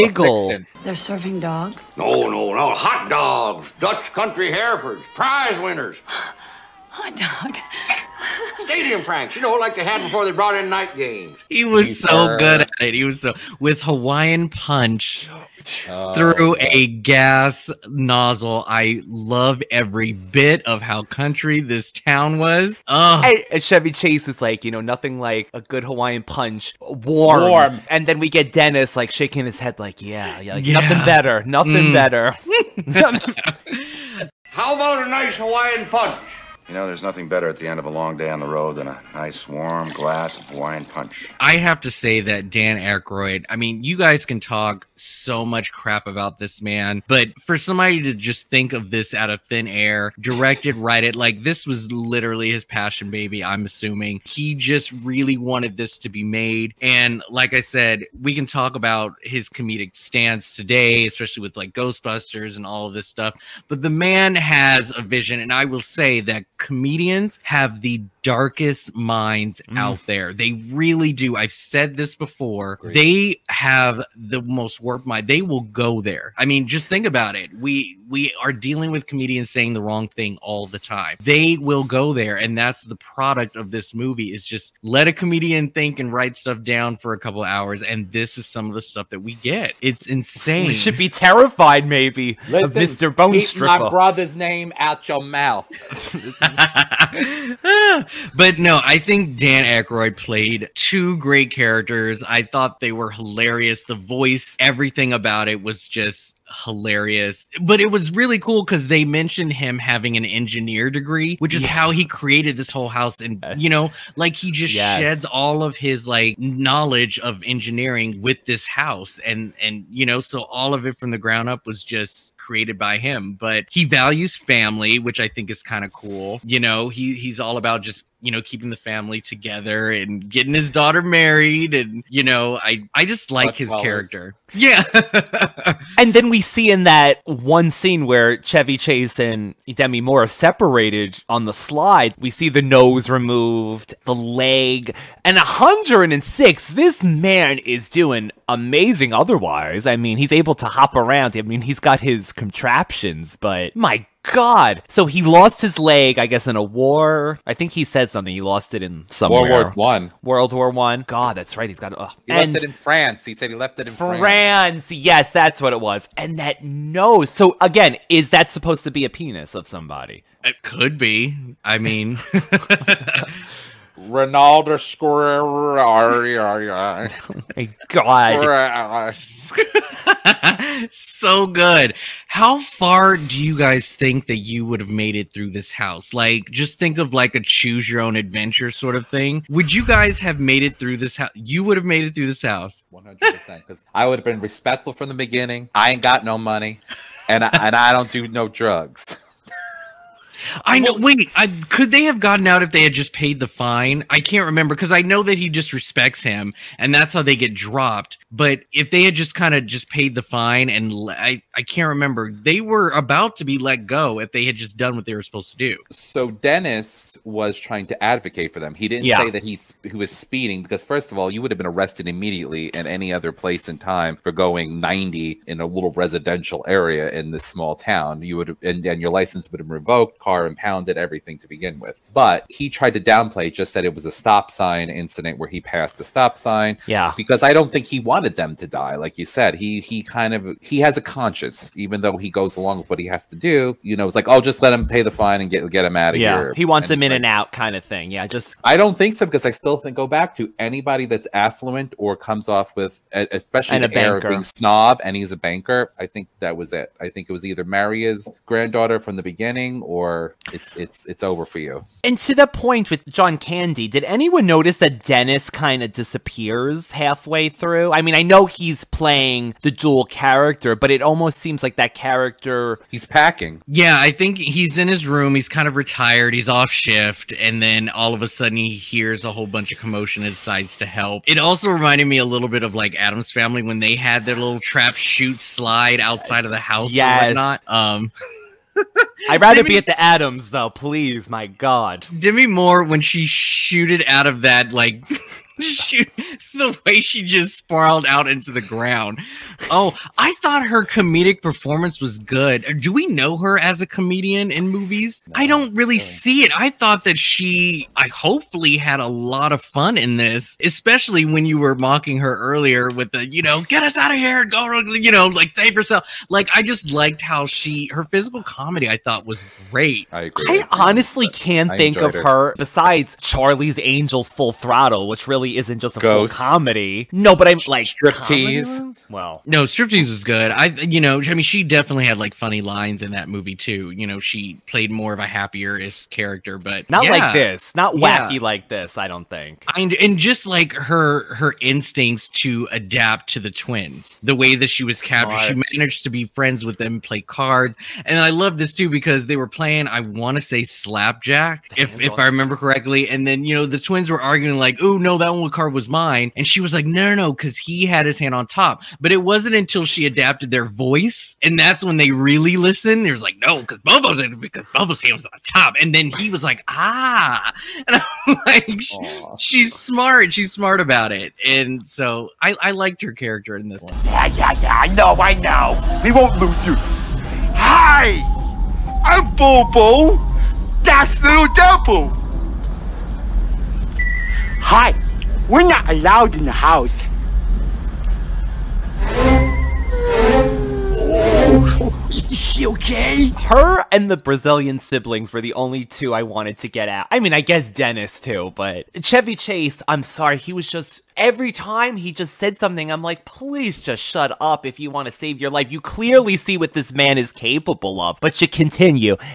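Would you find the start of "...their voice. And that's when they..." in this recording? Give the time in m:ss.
6:00.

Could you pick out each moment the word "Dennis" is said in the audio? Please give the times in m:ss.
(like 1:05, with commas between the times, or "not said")
0:28, 3:36, 4:25, 6:37.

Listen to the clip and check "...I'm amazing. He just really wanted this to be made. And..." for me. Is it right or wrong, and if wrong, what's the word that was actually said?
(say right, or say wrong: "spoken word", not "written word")
wrong: "assuming", not "amazing".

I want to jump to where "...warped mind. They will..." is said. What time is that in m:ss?
1:14.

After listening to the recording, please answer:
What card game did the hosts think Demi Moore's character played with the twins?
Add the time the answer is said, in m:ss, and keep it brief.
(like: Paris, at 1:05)
Slapjack, at 5:50.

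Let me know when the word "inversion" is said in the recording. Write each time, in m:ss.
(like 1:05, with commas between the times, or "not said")
not said.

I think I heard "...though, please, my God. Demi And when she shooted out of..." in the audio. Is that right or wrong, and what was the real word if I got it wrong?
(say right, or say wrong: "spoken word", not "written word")
wrong: "Moore", not "And".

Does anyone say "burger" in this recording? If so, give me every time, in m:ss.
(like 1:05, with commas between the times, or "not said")
not said.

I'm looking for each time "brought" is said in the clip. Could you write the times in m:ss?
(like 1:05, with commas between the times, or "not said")
0:10.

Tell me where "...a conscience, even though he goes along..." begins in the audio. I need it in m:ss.
4:00.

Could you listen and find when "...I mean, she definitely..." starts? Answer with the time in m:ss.
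5:31.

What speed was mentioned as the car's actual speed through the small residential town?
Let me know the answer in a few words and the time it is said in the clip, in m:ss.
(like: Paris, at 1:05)
90, at 3:44.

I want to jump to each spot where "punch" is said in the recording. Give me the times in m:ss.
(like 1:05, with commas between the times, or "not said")
0:14, 0:26, 0:35, 0:40.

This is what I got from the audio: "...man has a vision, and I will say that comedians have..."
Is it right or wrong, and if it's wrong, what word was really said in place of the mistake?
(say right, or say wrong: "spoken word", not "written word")
right.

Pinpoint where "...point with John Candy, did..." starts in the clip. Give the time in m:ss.
4:22.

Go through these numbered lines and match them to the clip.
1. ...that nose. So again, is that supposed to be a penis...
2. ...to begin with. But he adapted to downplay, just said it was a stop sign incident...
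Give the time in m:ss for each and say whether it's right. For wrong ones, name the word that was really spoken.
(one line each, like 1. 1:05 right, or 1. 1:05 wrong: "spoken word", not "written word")
1. 2:46 right
2. 3:51 wrong: "tried", not "adapted".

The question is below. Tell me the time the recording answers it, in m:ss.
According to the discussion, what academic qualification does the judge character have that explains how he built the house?
1:50.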